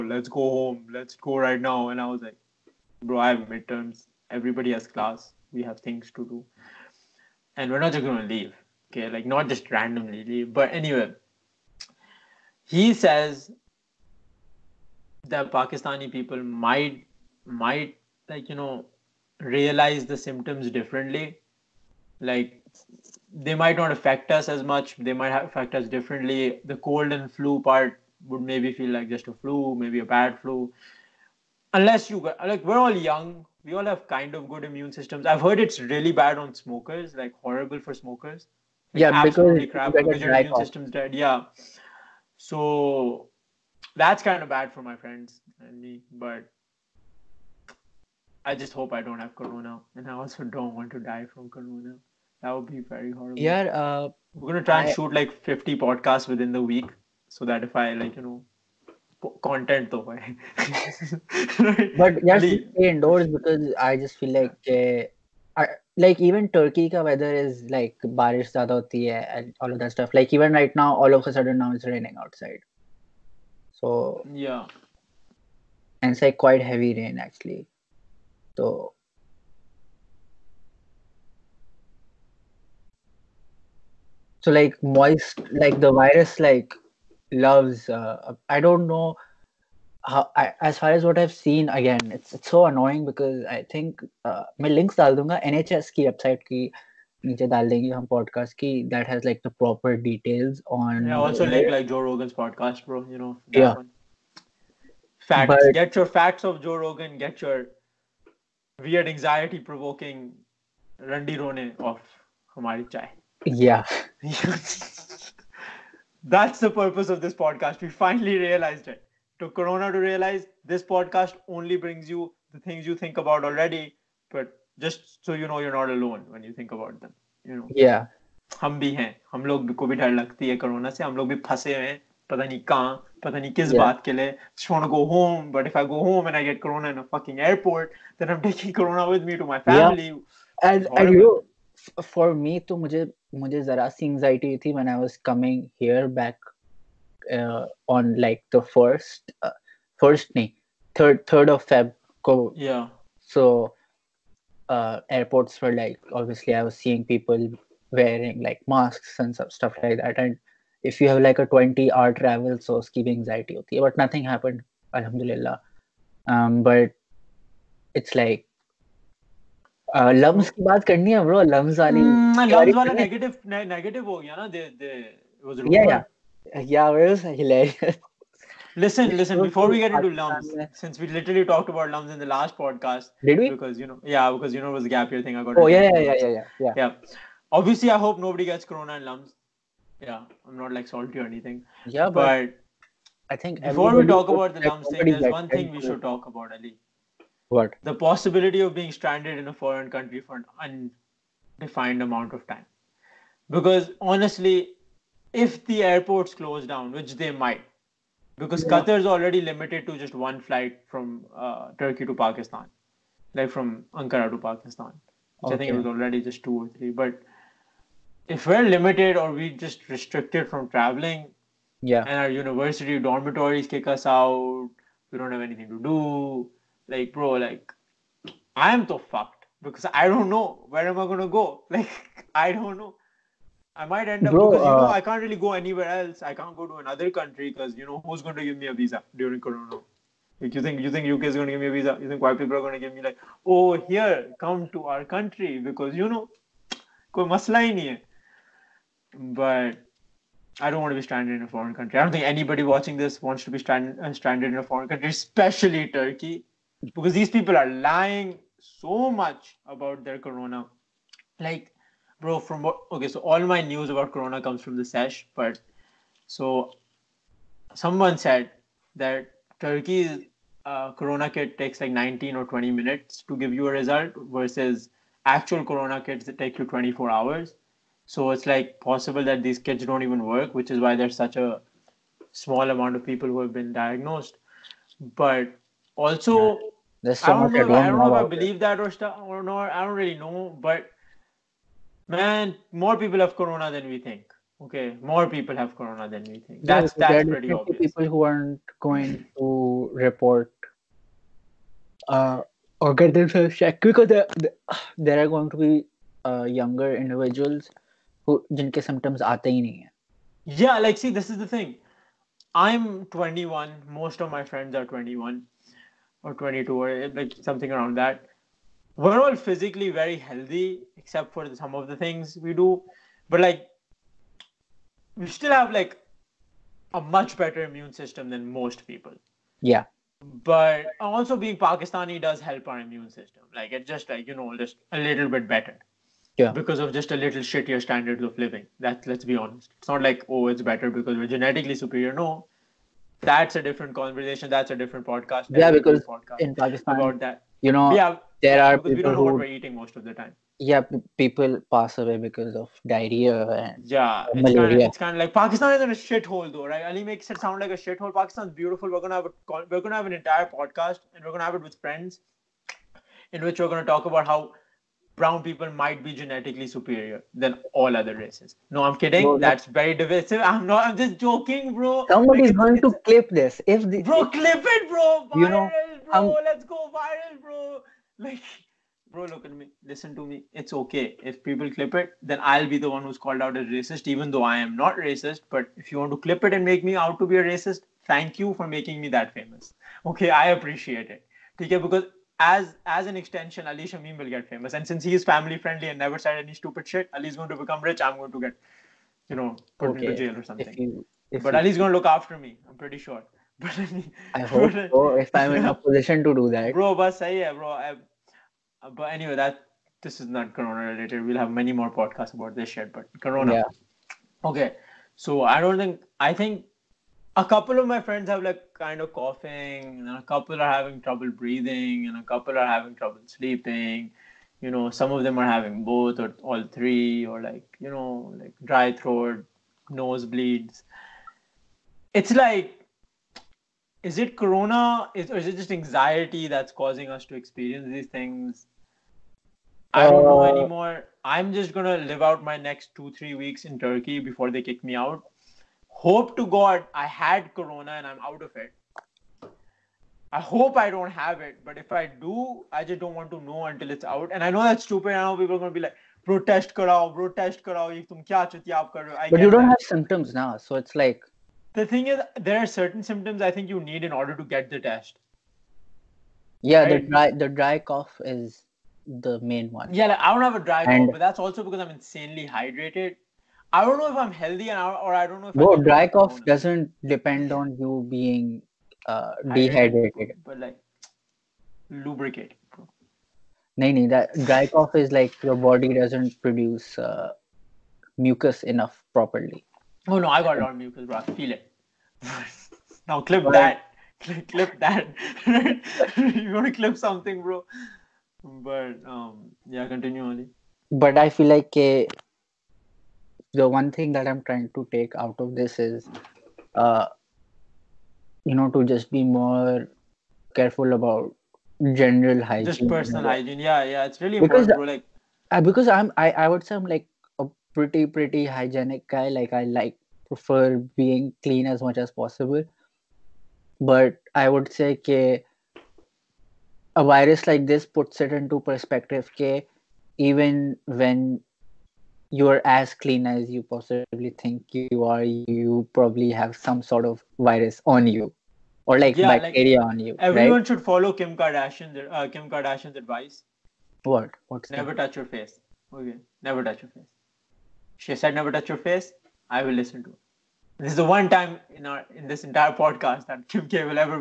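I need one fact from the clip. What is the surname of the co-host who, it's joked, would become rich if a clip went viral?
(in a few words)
Shamim.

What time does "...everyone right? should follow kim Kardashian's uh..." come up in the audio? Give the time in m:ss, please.
9:00.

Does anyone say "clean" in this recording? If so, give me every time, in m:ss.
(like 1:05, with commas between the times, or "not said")
8:41, 8:52.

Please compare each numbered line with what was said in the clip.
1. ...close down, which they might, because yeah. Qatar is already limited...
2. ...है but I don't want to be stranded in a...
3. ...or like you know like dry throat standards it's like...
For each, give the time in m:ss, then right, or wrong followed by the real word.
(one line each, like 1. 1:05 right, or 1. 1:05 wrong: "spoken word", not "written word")
1. 3:26 right
2. 4:07 right
3. 7:07 wrong: "nosebleeds", not "standards".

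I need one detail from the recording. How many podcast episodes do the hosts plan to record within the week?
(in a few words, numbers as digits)
50.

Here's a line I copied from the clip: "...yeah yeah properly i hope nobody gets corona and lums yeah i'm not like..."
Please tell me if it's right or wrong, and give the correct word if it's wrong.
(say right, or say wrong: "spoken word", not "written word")
wrong: "obviously", not "properly".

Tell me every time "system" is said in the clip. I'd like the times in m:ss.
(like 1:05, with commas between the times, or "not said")
0:34, 0:40, 5:27, 5:33.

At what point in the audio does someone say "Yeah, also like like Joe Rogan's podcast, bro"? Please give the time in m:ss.
1:41.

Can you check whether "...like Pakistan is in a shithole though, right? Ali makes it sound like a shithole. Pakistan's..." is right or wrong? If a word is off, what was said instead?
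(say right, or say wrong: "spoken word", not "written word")
right.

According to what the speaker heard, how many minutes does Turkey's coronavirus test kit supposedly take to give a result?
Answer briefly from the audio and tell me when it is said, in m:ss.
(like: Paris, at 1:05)
19 or 20 minutes, at 4:31.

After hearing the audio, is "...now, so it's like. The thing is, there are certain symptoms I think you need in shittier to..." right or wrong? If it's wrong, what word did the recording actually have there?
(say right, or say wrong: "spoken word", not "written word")
wrong: "order", not "shittier".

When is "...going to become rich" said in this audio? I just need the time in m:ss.
6:37.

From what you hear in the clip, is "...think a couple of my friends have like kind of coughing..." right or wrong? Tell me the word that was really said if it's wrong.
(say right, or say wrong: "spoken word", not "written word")
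right.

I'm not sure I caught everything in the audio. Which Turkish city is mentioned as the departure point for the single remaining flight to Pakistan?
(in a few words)
Ankara.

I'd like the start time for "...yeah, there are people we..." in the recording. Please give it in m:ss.
5:47.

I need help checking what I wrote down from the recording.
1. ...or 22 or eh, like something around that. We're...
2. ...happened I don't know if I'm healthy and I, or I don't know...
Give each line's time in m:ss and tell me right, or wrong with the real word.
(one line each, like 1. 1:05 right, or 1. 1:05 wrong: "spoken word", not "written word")
1. 5:16 right
2. 7:52 wrong: "hydrated", not "happened".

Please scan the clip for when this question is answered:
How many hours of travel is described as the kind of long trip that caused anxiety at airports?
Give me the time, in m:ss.
2:41.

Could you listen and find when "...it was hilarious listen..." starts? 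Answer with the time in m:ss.
2:56.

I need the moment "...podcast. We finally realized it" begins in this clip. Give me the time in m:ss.
1:57.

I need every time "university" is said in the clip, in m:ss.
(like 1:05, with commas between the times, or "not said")
3:42.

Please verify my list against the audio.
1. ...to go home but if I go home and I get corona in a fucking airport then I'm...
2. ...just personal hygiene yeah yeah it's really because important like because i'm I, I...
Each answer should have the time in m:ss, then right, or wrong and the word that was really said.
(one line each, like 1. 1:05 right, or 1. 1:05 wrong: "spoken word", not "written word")
1. 2:14 right
2. 8:32 right.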